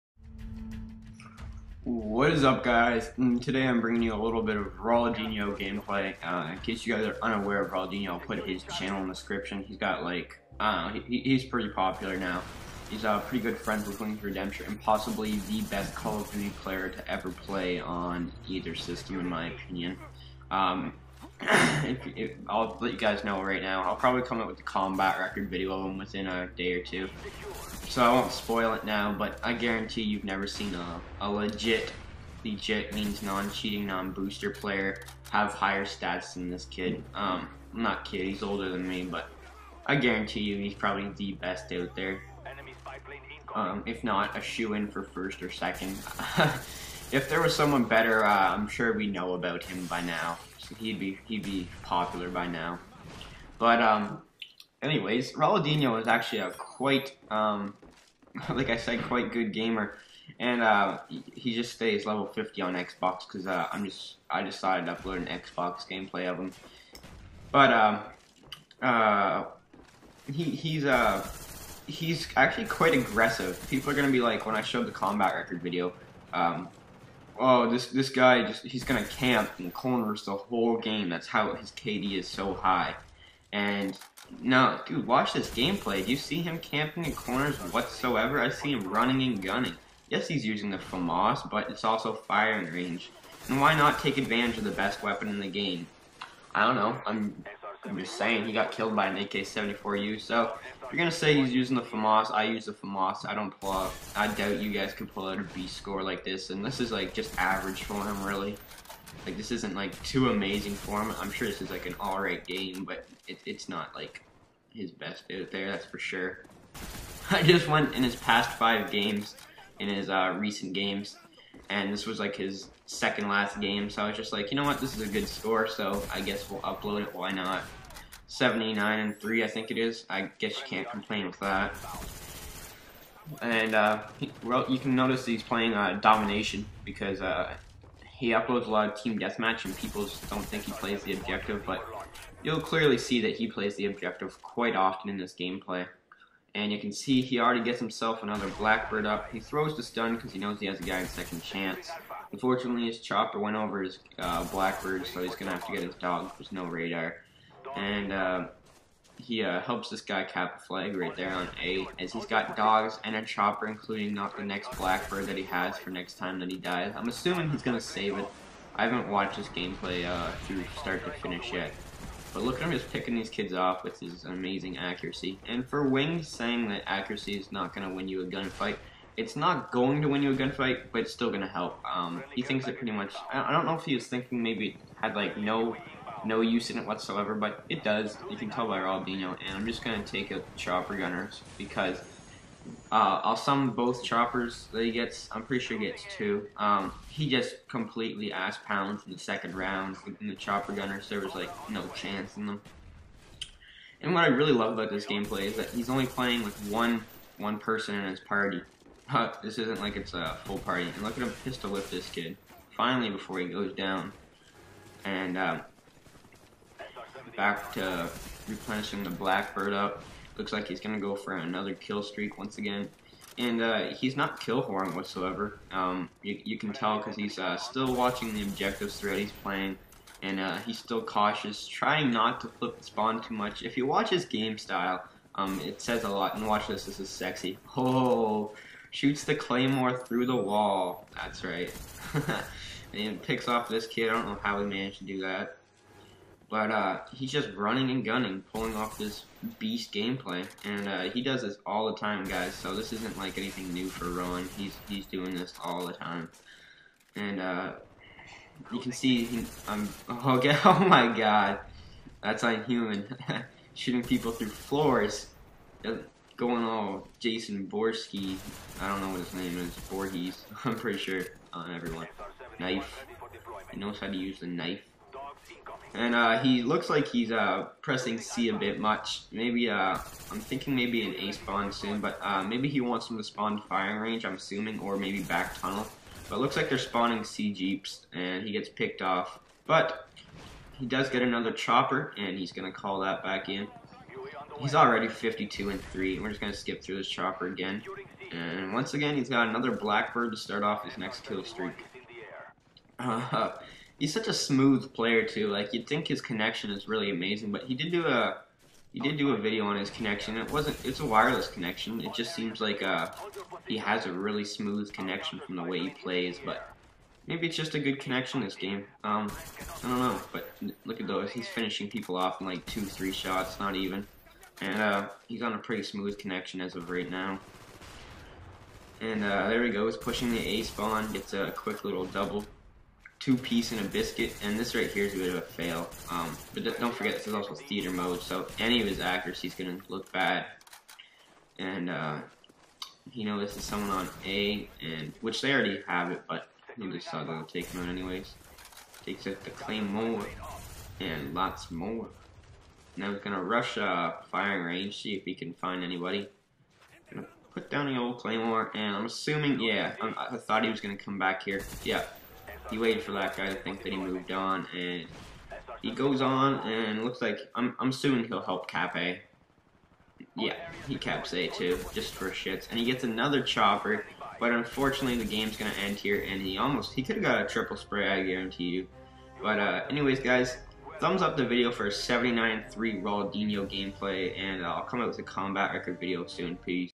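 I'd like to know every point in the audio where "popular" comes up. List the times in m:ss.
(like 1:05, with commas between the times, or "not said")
0:11, 0:51.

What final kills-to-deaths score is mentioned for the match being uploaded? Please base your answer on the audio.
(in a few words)
79 and 3.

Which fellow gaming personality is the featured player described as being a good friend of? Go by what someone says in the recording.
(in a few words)
Wings Redemption.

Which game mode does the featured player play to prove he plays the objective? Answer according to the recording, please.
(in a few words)
Domination.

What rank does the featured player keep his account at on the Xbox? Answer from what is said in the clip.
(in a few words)
level 50.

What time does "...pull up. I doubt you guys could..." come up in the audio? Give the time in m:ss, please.
1:43.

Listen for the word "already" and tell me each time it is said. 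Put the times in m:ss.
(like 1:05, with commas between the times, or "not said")
2:27, 4:54, 5:45.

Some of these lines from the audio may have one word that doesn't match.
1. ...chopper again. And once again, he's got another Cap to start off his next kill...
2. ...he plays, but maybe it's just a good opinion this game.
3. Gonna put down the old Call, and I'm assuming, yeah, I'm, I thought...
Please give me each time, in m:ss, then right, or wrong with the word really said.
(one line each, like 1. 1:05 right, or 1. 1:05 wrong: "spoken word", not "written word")
1. 4:57 wrong: "Blackbird", not "Cap"
2. 5:15 wrong: "connection", not "opinion"
3. 5:57 wrong: "Claymore", not "Call".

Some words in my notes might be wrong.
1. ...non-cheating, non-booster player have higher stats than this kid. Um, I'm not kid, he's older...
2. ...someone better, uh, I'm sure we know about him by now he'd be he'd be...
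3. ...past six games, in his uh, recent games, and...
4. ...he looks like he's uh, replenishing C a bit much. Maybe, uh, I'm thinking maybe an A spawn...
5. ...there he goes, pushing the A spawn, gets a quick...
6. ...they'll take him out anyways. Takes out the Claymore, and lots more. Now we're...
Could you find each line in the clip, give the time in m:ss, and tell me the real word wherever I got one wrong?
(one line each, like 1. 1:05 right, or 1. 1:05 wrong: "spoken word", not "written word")
1. 0:33 right
2. 0:47 right
3. 1:58 wrong: "five", not "six"
4. 4:36 wrong: "pressing", not "replenishing"
5. 5:29 right
6. 5:47 right.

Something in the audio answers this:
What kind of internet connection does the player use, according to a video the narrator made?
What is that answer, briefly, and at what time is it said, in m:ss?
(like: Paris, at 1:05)
wireless, at 5:11.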